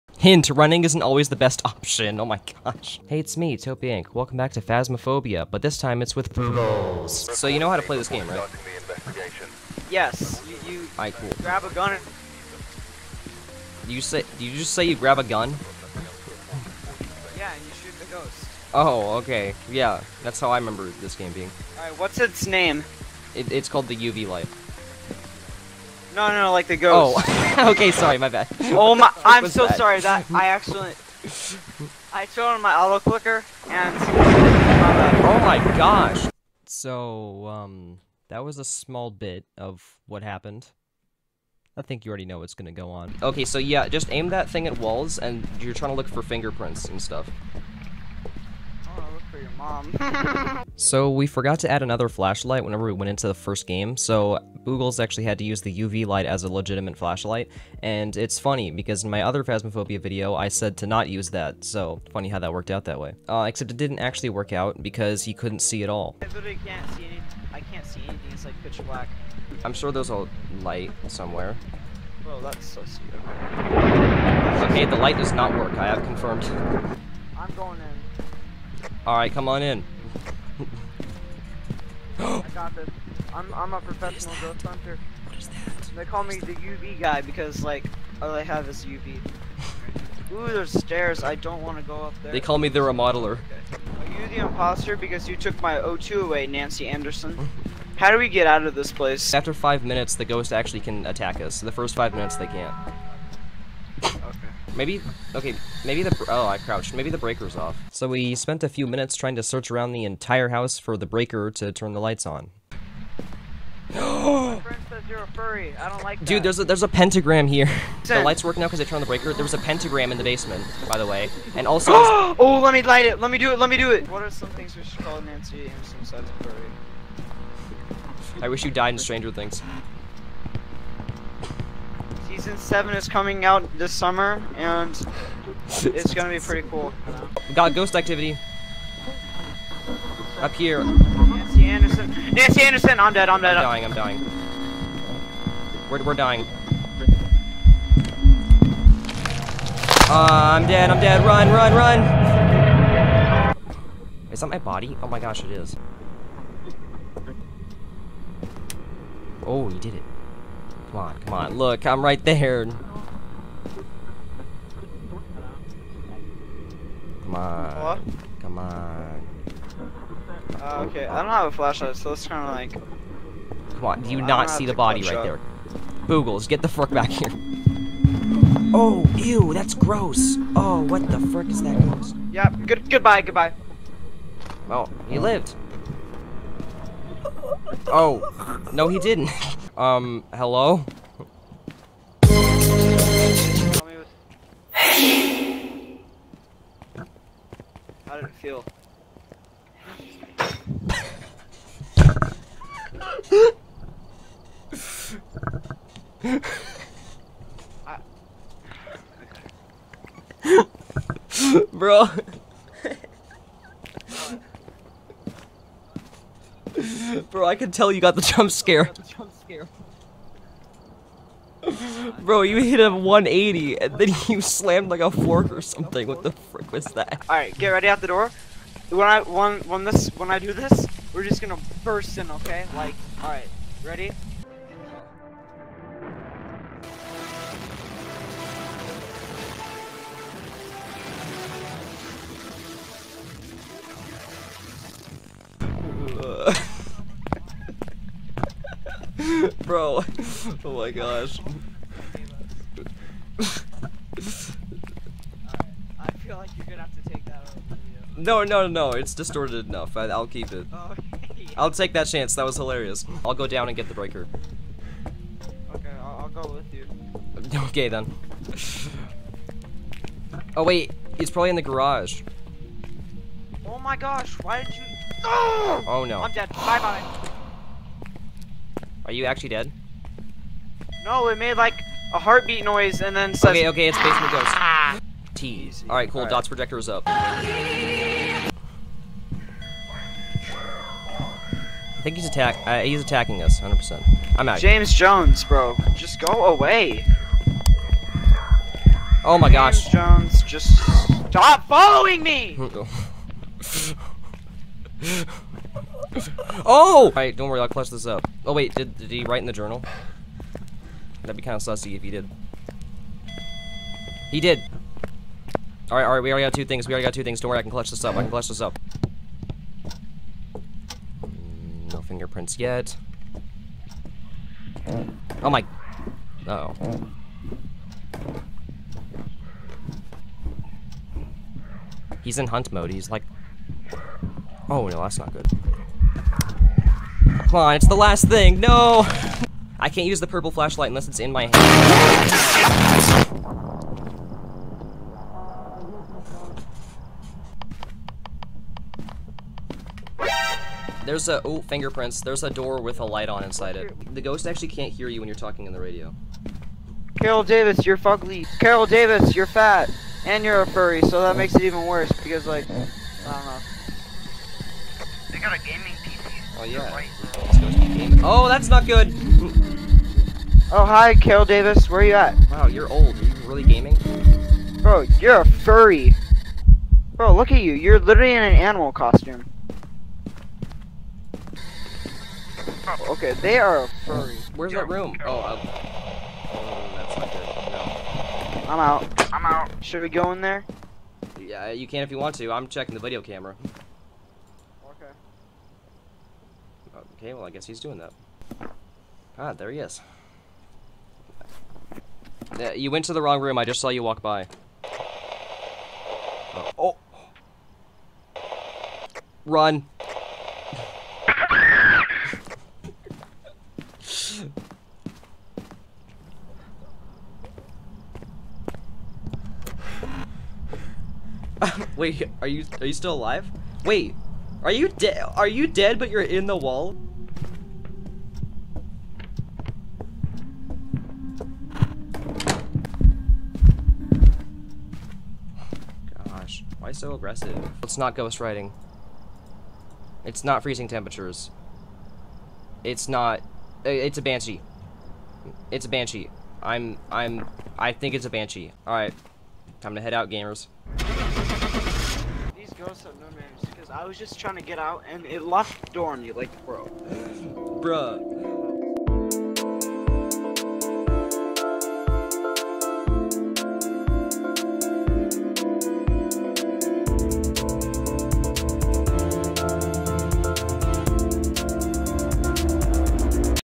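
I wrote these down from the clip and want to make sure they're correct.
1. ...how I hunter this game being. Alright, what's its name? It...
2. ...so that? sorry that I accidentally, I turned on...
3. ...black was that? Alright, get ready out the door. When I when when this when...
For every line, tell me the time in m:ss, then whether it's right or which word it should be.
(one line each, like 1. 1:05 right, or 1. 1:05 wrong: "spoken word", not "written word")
1. 0:20 wrong: "remember", not "hunter"
2. 0:29 right
3. 3:46 wrong: "frick", not "black".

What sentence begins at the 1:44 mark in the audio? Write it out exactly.
Maybe, okay, maybe the, oh, I crouched.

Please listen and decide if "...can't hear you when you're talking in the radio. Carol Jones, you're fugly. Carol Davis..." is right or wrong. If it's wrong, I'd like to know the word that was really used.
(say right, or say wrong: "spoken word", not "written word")
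wrong: "Davis", not "Jones".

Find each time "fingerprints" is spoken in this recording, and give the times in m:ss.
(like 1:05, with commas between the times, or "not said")
0:46, 5:22, 5:51.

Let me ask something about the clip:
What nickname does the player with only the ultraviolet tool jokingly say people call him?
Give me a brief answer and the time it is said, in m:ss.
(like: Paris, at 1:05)
The UV guy, at 1:26.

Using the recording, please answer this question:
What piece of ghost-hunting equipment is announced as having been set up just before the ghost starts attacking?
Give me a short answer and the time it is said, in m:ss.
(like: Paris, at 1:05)
DOTS projector, at 4:46.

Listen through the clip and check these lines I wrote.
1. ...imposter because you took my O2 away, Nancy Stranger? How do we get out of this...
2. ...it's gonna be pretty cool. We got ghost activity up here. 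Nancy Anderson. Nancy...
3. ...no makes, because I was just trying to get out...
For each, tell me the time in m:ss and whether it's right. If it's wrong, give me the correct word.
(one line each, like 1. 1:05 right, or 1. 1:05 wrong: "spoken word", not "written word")
1. 1:34 wrong: "Anderson", not "Stranger"
2. 2:15 right
3. 7:33 wrong: "names", not "makes".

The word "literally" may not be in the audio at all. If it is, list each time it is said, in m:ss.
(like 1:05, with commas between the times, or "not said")
1:06, 6:17.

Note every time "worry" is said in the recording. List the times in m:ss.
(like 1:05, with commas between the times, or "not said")
5:07, 5:17.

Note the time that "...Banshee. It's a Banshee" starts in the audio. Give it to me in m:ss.
7:24.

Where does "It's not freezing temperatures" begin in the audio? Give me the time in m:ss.
7:20.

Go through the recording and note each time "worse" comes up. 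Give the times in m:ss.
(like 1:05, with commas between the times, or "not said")
6:01.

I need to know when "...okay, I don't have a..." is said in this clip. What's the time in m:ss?
2:50.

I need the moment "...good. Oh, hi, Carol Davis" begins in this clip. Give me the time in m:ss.
6:08.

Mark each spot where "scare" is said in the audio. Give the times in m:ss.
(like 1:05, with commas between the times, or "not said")
3:38.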